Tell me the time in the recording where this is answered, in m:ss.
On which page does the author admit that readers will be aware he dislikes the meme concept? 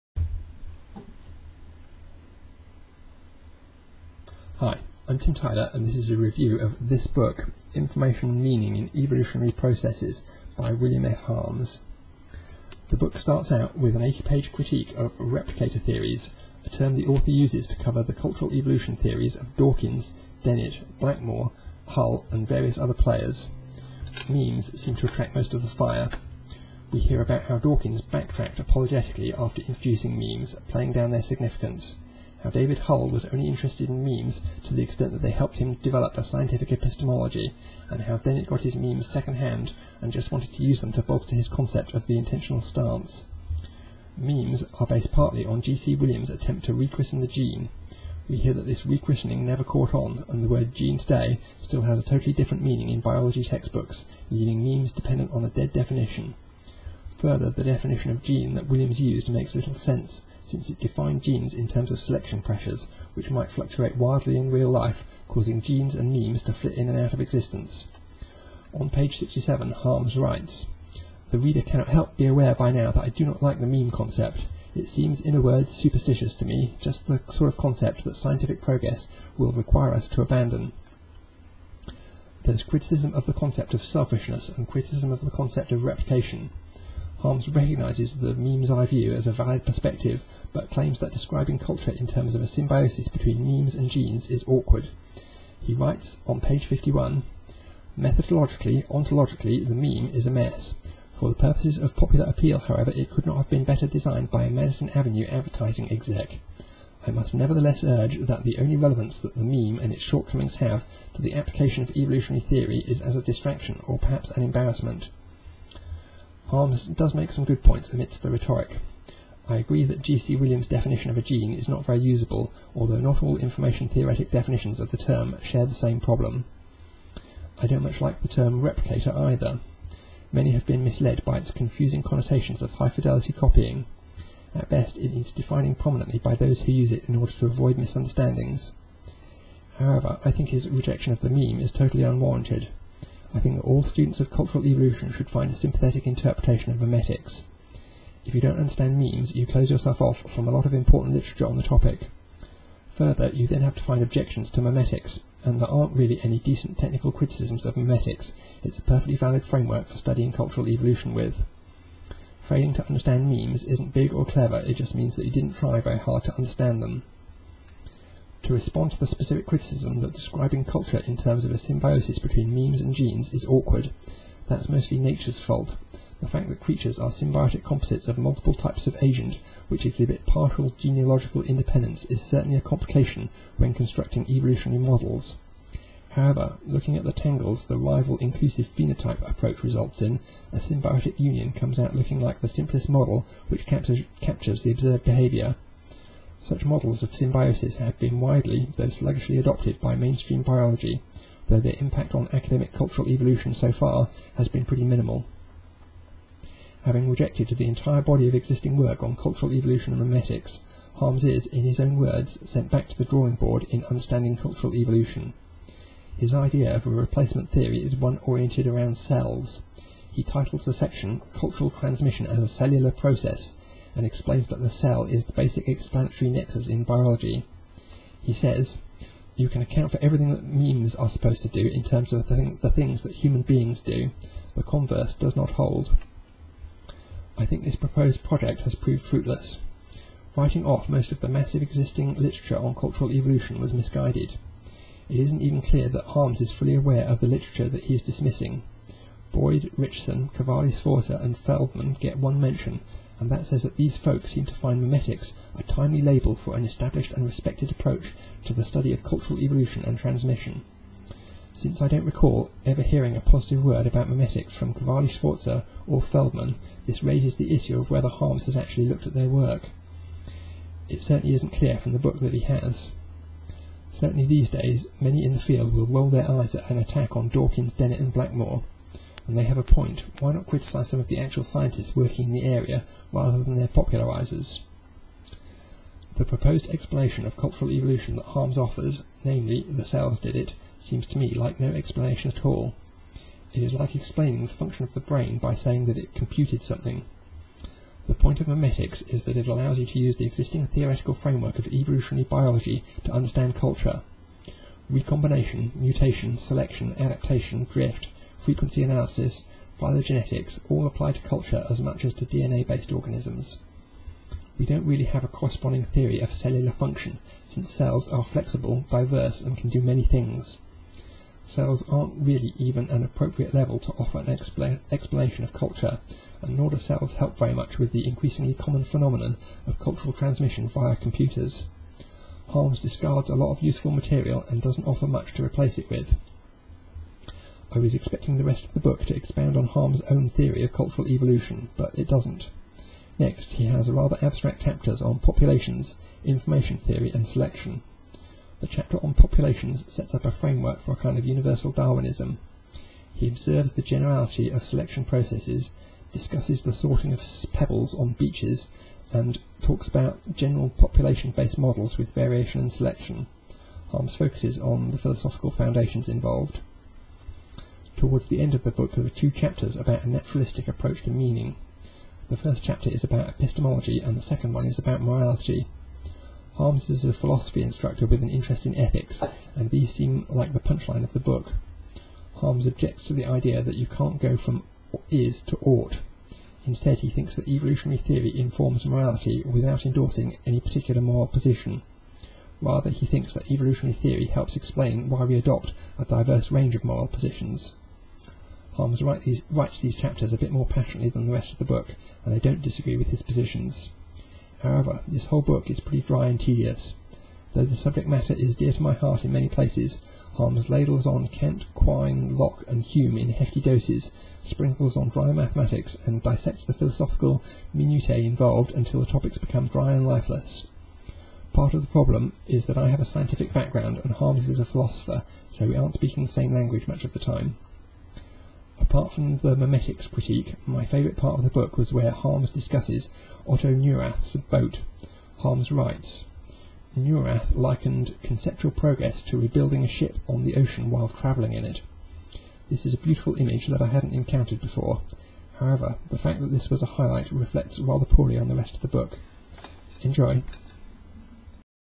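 1:08.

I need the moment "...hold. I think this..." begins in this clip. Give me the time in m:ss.
3:55.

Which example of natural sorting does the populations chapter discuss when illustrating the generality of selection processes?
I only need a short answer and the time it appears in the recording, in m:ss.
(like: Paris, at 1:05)
pebbles on beaches, at 5:57.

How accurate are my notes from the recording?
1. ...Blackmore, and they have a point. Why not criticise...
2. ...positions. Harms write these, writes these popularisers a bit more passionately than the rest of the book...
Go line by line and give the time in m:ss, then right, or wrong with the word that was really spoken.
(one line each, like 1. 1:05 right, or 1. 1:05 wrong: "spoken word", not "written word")
1. 4:38 right
2. 6:37 wrong: "chapters", not "popularisers".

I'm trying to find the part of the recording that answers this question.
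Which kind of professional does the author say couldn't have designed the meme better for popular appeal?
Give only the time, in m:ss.
1:44.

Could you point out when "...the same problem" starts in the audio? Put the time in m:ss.
2:05.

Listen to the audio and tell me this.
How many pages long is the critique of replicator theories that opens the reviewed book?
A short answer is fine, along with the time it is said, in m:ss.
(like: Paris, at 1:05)
80, at 0:14.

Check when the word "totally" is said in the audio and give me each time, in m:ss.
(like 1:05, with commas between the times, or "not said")
0:52, 2:21.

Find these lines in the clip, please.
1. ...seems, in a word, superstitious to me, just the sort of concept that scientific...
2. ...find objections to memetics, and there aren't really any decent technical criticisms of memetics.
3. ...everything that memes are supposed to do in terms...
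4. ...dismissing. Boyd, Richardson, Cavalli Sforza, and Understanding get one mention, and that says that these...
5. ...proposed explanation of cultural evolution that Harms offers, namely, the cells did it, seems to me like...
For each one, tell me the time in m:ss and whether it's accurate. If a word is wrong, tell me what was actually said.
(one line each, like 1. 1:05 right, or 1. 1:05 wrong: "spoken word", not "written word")
1. 1:14 right
2. 2:33 right
3. 3:50 right
4. 4:08 wrong: "Feldman", not "Understanding"
5. 4:46 right.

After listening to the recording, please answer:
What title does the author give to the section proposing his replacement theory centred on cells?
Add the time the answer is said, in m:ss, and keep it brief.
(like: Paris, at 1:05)
Cultural Transmission as a Cellular Process, at 3:41.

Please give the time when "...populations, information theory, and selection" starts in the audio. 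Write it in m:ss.
5:45.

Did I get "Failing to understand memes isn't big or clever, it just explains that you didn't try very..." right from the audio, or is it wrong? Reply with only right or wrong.
wrong.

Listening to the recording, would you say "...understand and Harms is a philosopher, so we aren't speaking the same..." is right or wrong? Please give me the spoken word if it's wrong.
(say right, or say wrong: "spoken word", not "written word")
wrong: "background", not "understand".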